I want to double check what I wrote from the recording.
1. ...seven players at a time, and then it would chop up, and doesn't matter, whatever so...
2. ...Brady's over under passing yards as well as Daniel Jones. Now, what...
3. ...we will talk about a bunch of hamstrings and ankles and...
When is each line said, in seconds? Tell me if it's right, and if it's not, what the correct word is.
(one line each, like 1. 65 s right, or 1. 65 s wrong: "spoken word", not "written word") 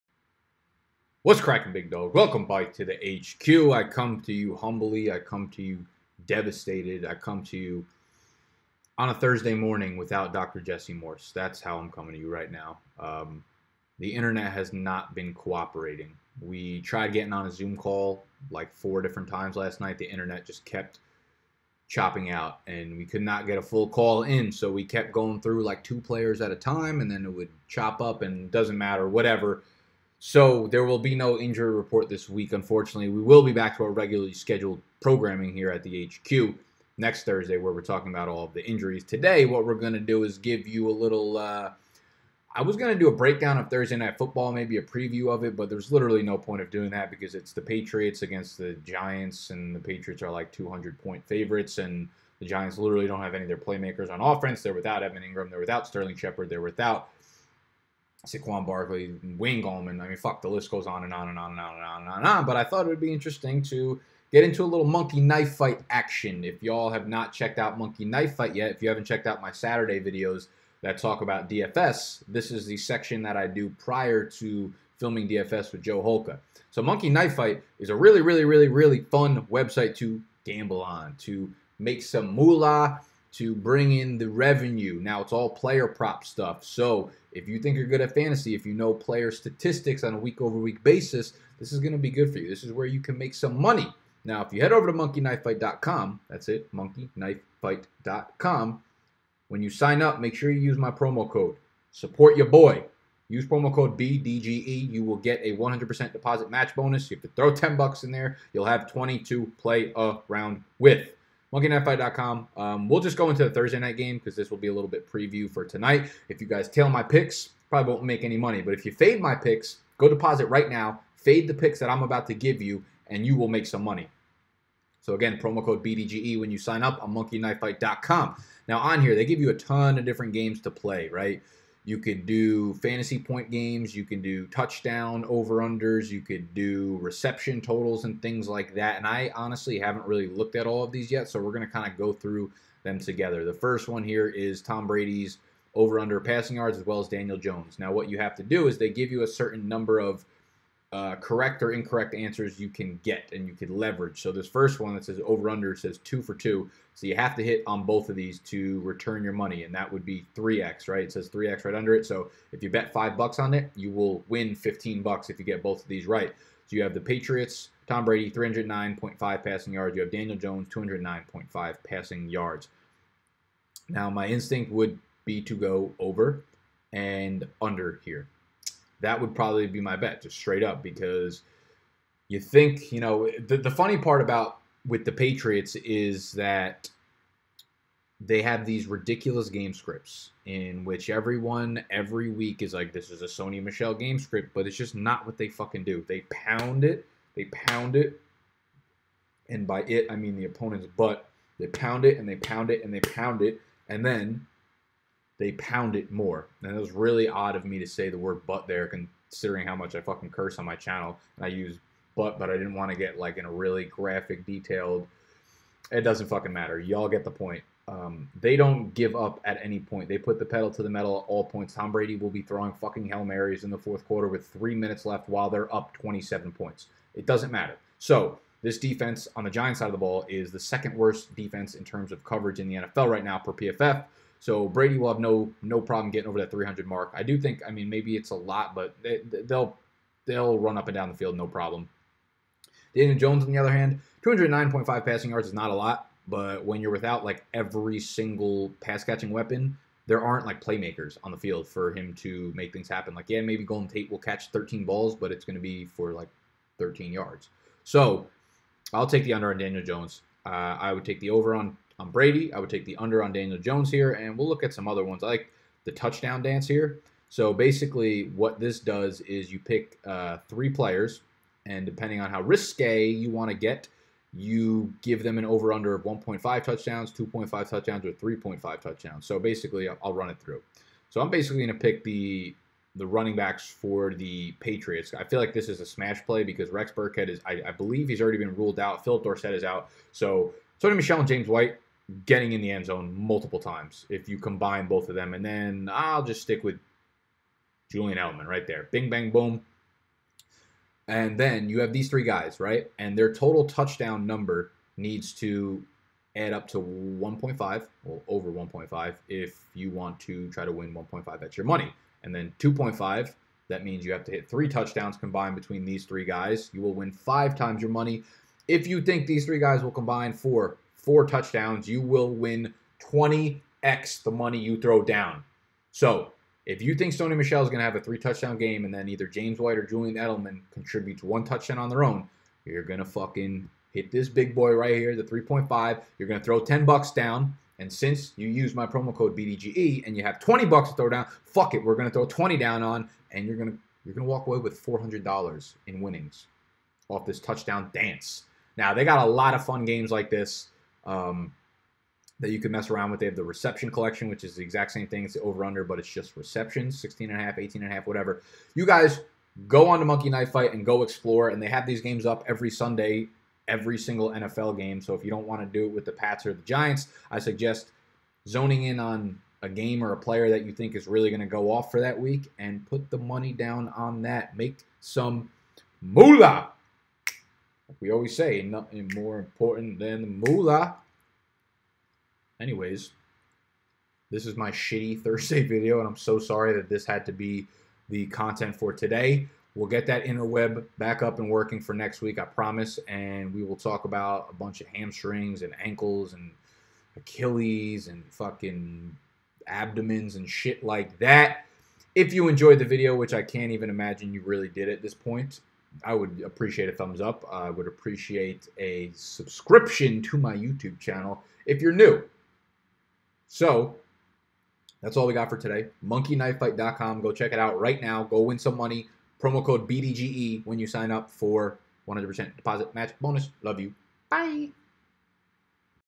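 1. 25 s wrong: "two", not "seven"
2. 144 s right
3. 393 s right.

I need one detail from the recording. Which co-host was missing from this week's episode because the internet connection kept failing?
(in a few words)
Dr. Jesse Morse.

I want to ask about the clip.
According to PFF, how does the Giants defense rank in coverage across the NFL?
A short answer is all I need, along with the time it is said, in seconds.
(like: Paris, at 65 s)
second worst, at 230 s.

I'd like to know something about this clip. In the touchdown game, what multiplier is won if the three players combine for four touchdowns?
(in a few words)
20x.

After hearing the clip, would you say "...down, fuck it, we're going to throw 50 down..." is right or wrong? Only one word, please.
wrong.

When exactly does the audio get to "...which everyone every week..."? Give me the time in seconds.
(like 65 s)
190 s.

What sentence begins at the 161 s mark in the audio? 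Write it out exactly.
It says 3x right under it.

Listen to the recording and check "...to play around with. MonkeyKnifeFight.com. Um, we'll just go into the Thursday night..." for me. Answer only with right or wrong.
right.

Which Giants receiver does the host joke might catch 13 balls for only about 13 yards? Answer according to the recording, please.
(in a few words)
Golden Tate.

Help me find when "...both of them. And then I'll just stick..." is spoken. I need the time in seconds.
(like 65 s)
294 s.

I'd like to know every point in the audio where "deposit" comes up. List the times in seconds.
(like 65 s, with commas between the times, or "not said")
106 s, 120 s, 422 s.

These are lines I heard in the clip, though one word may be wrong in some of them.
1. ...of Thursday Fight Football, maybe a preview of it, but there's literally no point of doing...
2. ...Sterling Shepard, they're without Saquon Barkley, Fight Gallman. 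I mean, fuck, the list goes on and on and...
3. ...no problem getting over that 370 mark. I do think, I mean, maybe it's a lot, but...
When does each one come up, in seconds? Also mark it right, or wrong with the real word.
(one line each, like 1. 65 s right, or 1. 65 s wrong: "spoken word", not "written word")
1. 43 s wrong: "Night", not "Fight"
2. 55 s wrong: "Wayne", not "Fight"
3. 235 s wrong: "300", not "370".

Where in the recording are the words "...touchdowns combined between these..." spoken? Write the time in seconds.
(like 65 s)
314 s.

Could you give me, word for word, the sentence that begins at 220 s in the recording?
They put the pedal to the metal at all points.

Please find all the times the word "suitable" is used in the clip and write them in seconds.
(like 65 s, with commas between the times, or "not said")
not said.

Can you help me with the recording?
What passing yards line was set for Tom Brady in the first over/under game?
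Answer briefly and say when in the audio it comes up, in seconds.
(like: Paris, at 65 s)
309.5, at 168 s.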